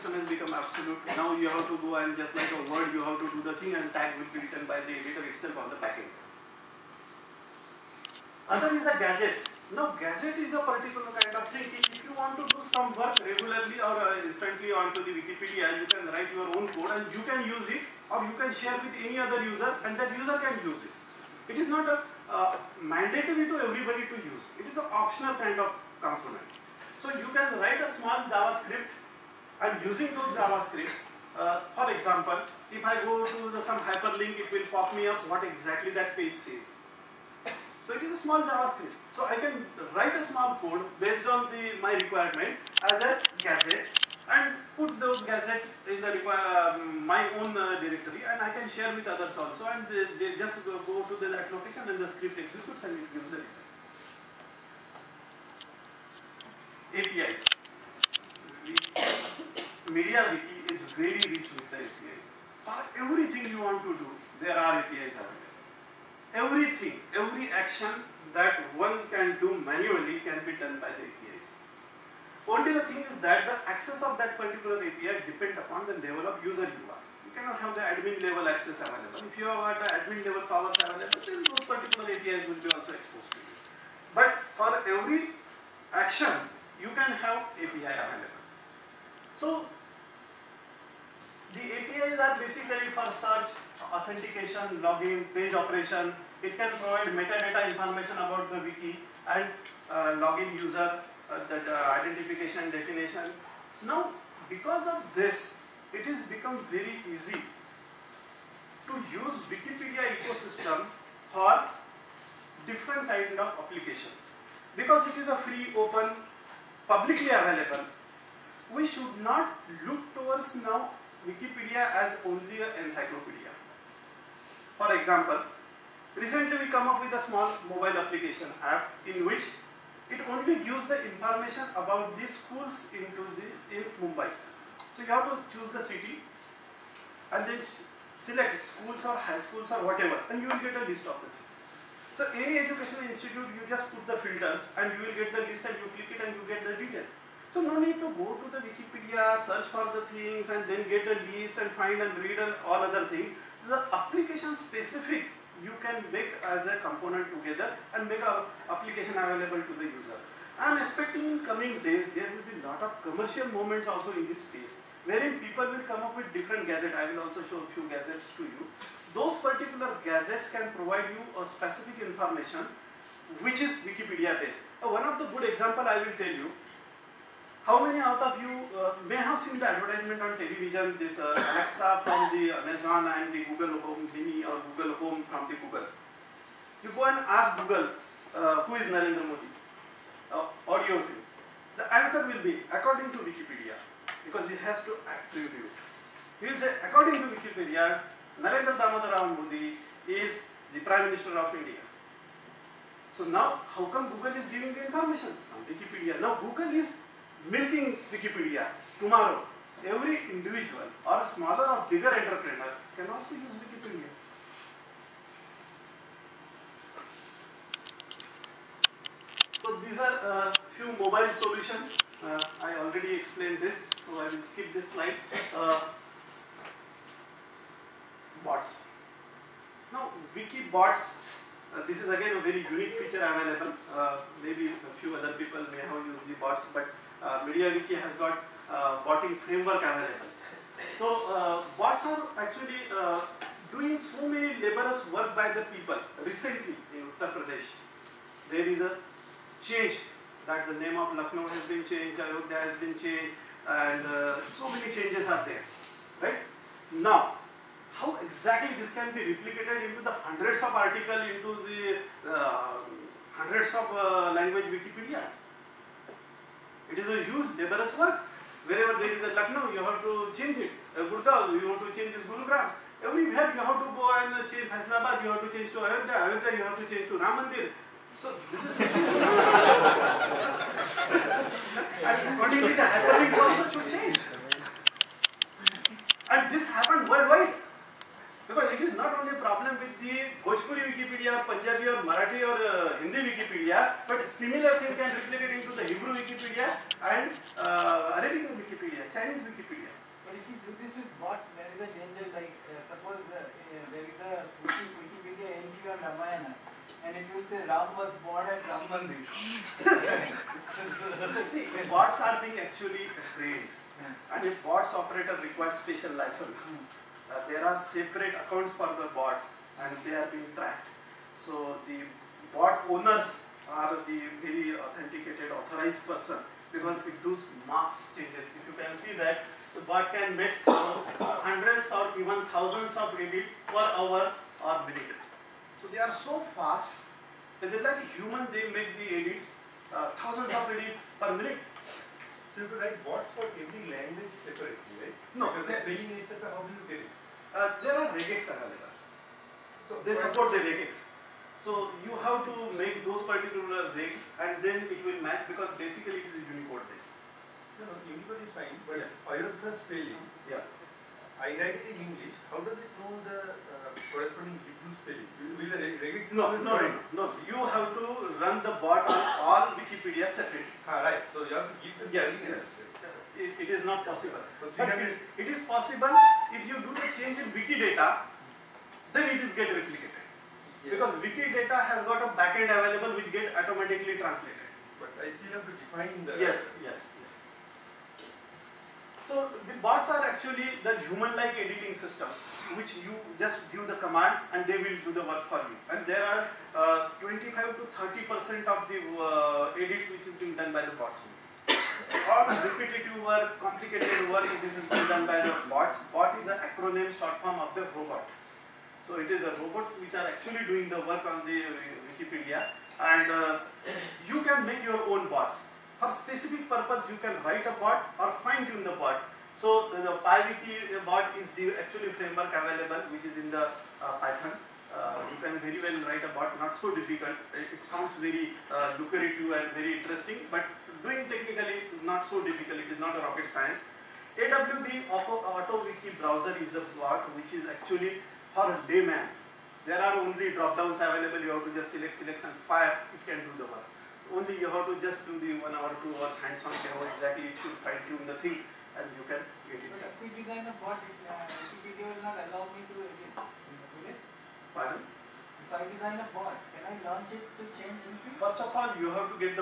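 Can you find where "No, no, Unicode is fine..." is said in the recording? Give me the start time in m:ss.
5:57.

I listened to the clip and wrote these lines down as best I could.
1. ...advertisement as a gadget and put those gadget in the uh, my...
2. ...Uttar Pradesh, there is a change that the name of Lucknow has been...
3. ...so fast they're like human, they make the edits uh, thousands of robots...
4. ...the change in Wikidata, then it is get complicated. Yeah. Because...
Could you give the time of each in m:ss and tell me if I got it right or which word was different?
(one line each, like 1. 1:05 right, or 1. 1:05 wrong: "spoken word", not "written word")
1. 0:41 wrong: "requirement", not "advertisement"
2. 4:07 right
3. 5:36 wrong: "edits", not "robots"
4. 6:16 wrong: "replicated", not "complicated".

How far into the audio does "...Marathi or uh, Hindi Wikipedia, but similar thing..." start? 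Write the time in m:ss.
4:52.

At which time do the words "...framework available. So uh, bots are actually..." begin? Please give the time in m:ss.
3:59.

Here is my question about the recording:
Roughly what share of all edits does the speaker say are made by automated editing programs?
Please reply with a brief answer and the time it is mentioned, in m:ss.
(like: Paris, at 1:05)
25 to 30%, at 6:37.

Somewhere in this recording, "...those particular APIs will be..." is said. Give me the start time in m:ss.
1:21.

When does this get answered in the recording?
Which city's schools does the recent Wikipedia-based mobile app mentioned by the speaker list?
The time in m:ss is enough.
2:14.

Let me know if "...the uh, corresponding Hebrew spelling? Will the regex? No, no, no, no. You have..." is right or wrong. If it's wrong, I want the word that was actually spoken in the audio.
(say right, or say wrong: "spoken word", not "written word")
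right.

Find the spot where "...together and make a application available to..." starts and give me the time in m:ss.
2:37.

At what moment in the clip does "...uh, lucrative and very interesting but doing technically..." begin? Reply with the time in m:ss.
7:08.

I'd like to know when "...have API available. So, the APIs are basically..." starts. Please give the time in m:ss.
1:27.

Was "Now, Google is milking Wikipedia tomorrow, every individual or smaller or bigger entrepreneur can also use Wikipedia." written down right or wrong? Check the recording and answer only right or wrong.
right.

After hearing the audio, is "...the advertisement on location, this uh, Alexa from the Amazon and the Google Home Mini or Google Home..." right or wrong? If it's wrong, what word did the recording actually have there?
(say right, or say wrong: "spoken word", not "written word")
wrong: "television", not "location".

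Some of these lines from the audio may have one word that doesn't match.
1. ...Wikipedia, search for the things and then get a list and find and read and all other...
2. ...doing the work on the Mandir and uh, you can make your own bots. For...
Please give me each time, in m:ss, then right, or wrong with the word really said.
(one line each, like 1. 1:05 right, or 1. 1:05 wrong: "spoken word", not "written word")
1. 2:28 right
2. 6:50 wrong: "Wikipedia", not "Mandir".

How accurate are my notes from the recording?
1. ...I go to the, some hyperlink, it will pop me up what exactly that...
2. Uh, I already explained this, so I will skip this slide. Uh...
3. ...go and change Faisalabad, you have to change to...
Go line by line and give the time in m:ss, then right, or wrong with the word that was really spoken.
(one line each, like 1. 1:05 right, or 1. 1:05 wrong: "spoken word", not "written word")
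1. 0:32 right
2. 3:42 right
3. 4:33 right.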